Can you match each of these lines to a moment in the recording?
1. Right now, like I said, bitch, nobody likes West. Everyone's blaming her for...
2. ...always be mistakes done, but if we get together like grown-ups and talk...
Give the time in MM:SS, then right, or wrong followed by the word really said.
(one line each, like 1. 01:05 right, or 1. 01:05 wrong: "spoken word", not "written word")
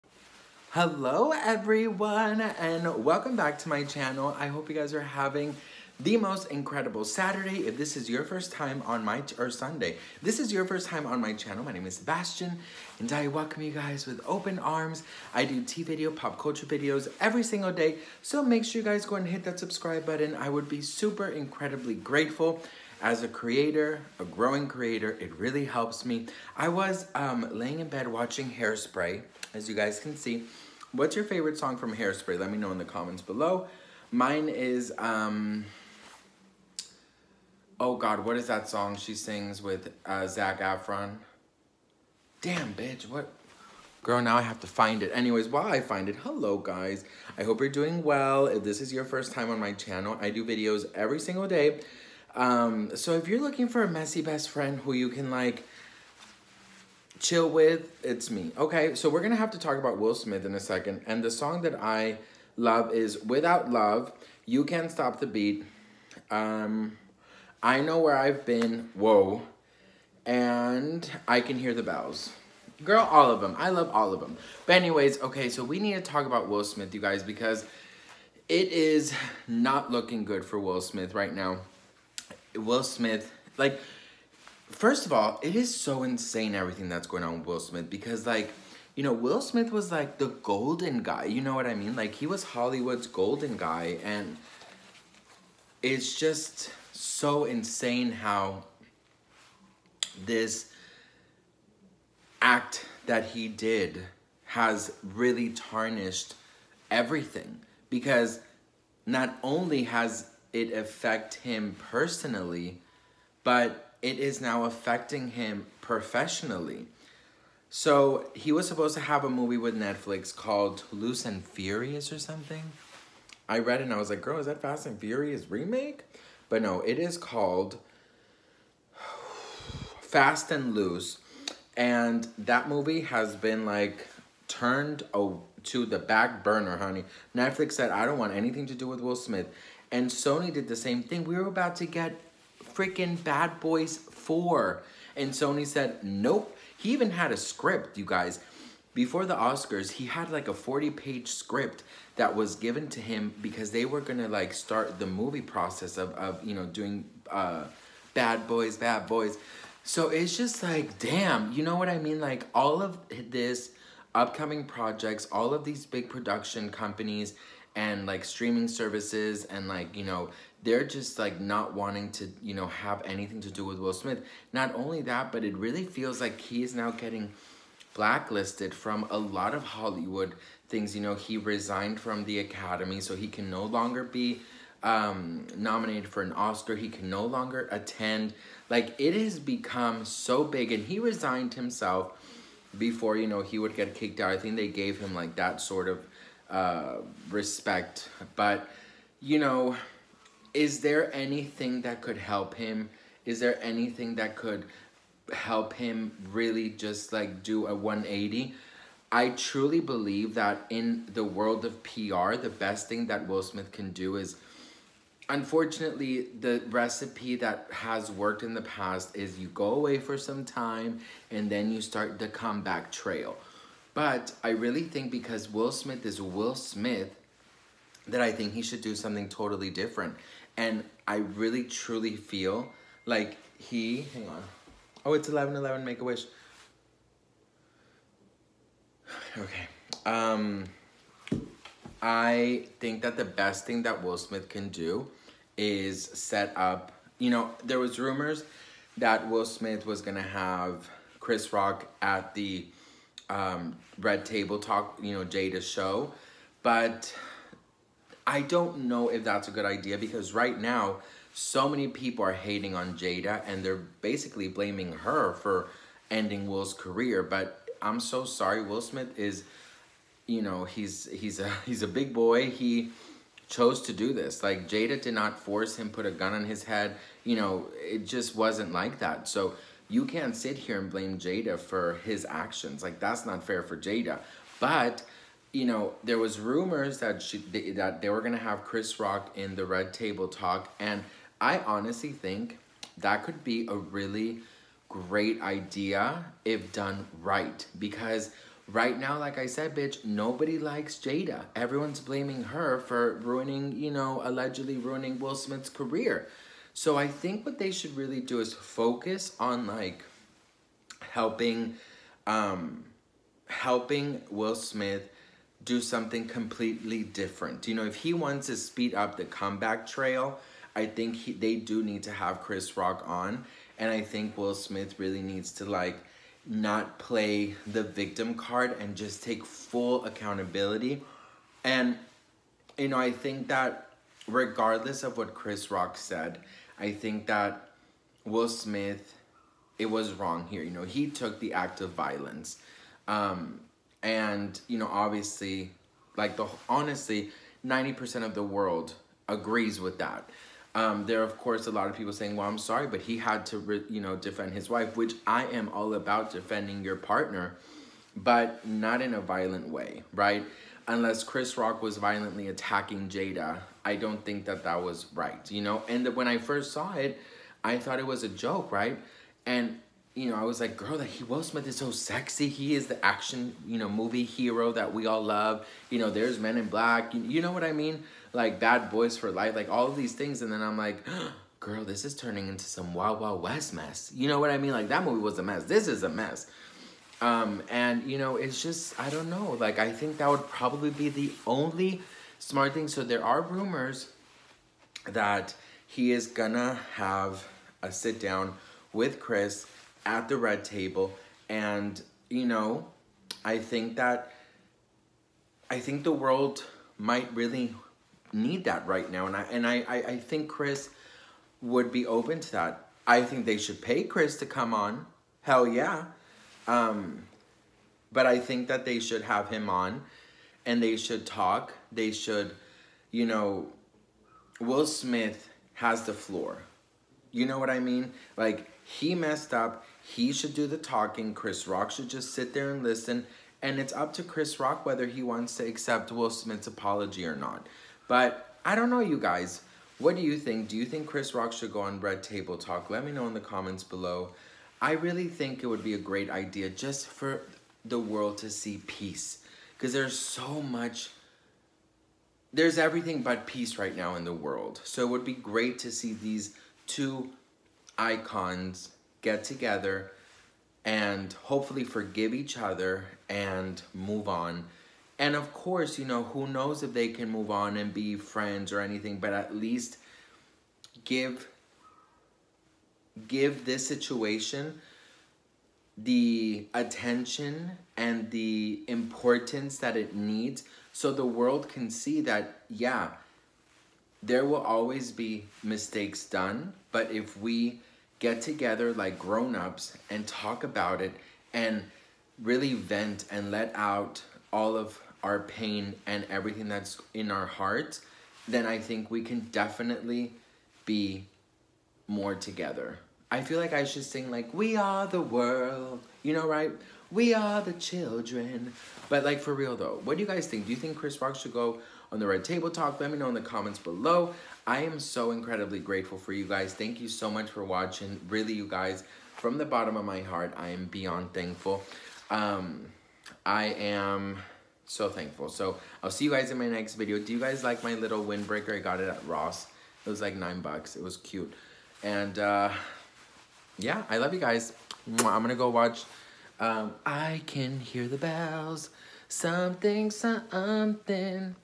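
1. 04:58 wrong: "Jada", not "West"
2. 08:04 right.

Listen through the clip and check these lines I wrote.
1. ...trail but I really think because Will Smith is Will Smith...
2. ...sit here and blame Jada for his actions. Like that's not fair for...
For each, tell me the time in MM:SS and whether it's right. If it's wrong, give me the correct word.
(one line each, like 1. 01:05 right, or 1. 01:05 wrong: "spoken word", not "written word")
1. 03:42 right
2. 04:40 right.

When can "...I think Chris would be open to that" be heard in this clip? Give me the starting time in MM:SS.
06:49.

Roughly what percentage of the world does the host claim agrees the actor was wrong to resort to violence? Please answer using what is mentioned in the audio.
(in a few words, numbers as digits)
90%.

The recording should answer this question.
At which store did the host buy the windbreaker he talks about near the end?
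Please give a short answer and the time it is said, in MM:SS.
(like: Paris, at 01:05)
Ross, at 08:49.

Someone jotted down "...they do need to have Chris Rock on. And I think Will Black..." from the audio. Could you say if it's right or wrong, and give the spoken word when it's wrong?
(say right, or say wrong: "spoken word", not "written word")
wrong: "Smith", not "Black".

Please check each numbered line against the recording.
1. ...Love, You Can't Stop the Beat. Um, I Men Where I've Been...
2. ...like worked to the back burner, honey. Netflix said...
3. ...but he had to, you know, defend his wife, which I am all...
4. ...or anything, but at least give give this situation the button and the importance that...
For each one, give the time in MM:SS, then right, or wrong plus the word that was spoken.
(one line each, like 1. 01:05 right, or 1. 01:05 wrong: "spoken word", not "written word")
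1. 01:03 wrong: "Know", not "Men"
2. 02:13 wrong: "turned", not "worked"
3. 05:52 right
4. 07:48 wrong: "attention", not "button".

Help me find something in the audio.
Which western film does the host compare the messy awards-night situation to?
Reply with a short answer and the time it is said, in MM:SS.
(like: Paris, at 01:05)
Wild Wild West, at 06:22.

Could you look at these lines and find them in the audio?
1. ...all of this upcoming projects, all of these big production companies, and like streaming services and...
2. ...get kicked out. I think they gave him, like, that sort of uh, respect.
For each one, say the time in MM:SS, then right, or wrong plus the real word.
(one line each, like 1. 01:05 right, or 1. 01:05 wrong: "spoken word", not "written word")
1. 02:42 right
2. 03:13 right.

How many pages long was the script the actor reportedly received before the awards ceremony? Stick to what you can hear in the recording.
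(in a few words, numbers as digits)
40.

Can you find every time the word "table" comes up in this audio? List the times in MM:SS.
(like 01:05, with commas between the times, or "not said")
04:14, 04:49, 06:40, 07:22, 08:32.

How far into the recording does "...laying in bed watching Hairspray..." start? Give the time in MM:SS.
00:27.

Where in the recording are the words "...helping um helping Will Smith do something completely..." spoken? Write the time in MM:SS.
05:11.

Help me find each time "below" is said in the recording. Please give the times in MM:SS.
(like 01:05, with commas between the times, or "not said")
00:33, 07:23, 08:33.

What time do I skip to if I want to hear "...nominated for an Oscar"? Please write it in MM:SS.
03:05.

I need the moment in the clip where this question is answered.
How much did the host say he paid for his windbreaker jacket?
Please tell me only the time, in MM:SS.
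08:50.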